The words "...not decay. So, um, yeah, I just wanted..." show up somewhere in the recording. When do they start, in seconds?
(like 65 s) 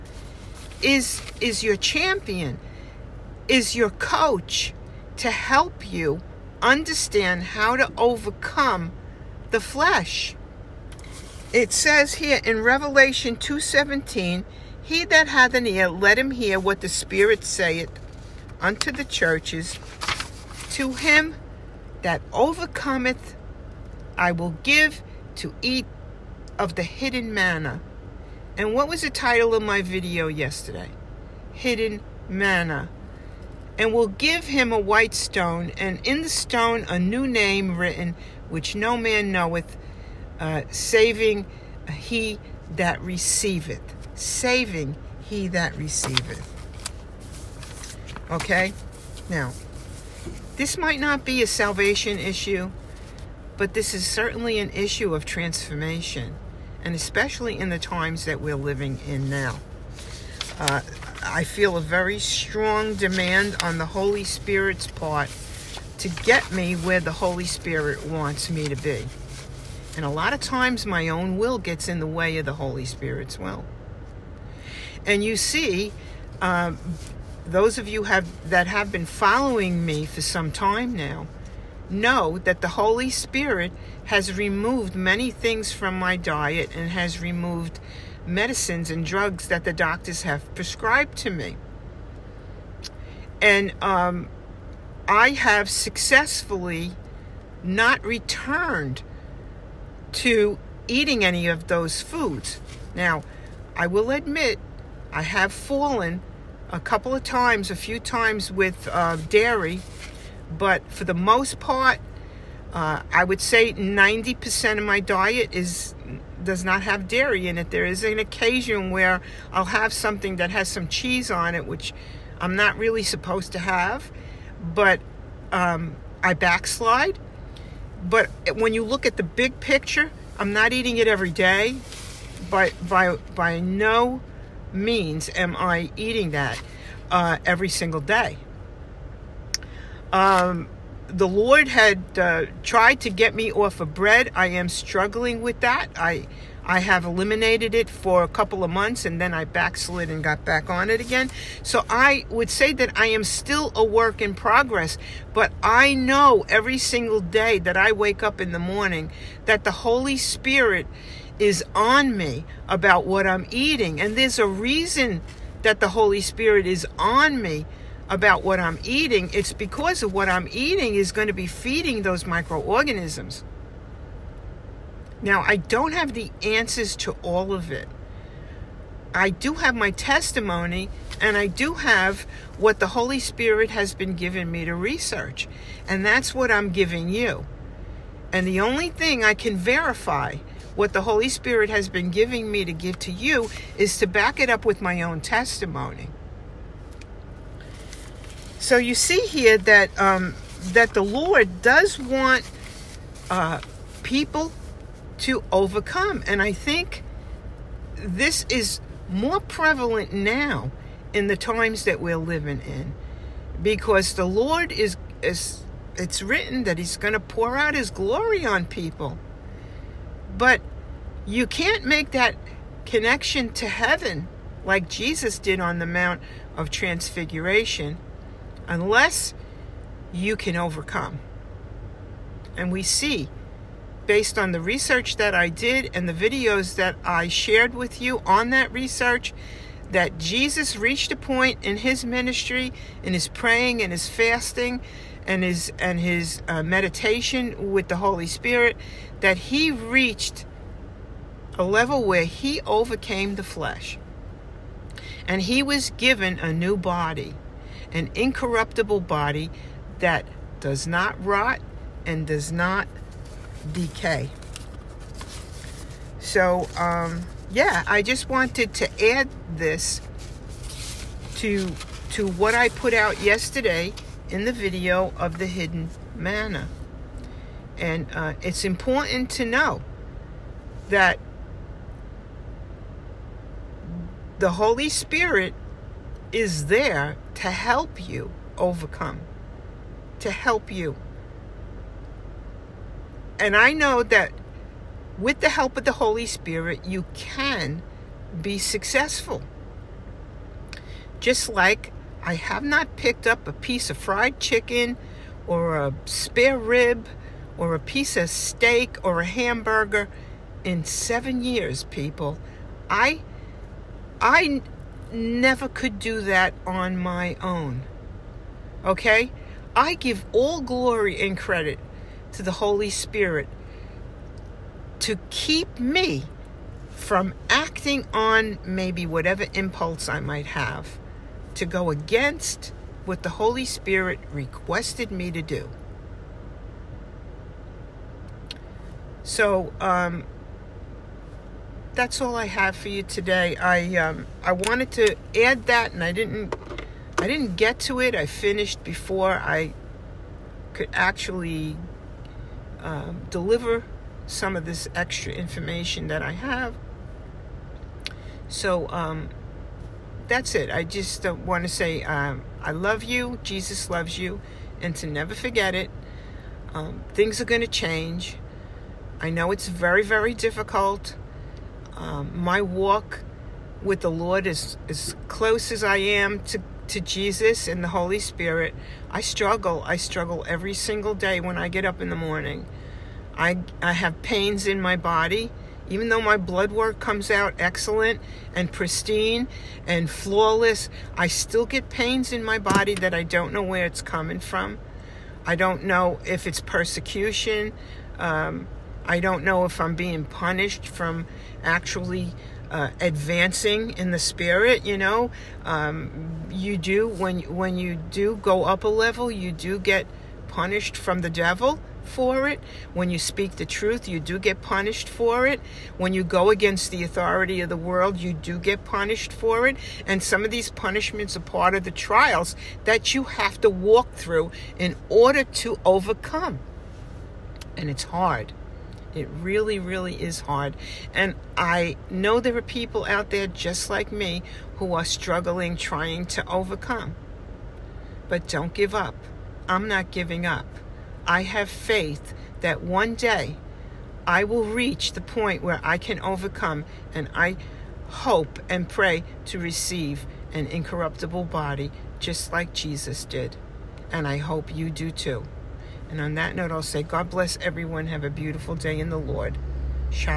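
262 s.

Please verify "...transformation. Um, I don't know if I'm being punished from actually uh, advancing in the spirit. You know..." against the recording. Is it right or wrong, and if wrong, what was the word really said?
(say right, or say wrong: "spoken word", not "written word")
wrong: "persecution", not "transformation".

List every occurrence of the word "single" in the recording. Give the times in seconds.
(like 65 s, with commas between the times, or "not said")
137 s, 156 s, 380 s.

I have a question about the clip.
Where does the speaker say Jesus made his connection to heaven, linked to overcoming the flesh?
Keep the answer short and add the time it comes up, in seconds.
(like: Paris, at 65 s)
Mount of Transfiguration, at 225 s.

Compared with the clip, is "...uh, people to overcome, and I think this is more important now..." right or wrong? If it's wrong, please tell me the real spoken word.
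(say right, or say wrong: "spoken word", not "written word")
wrong: "prevalent", not "important".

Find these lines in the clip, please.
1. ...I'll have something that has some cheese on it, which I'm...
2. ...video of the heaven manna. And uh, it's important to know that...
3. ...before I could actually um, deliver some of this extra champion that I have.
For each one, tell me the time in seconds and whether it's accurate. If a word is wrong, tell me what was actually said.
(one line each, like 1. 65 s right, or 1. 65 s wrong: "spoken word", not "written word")
1. 119 s right
2. 274 s wrong: "hidden", not "heaven"
3. 348 s wrong: "information", not "champion".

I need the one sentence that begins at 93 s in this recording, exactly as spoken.
And um, I have successfully not returned to eating any of those foods.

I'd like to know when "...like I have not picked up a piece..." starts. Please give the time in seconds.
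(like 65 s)
301 s.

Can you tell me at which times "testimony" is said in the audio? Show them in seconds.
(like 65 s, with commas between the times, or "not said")
179 s, 195 s.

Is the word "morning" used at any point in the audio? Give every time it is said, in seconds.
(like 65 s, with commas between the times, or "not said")
158 s, 382 s.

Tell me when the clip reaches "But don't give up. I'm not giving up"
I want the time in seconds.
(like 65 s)
438 s.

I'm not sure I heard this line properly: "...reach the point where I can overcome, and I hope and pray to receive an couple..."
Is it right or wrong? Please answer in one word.
wrong.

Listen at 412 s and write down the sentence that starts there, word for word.
When you speak the truth, you do get punished for it.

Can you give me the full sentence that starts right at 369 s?
I know it's very, very difficult.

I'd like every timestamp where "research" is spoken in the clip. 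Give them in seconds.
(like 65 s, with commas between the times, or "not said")
184 s, 234 s, 238 s.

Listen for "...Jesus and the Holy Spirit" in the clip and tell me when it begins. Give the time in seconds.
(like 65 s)
377 s.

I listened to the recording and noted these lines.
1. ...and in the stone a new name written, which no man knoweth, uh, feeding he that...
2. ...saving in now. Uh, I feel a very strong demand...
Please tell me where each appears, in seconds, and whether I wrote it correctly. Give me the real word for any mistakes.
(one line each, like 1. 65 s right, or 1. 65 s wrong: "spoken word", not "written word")
1. 35 s wrong: "saving", not "feeding"
2. 58 s wrong: "living", not "saving".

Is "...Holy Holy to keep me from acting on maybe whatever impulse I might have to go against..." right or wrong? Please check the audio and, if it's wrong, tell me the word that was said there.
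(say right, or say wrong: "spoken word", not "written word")
wrong: "Spirit", not "Holy".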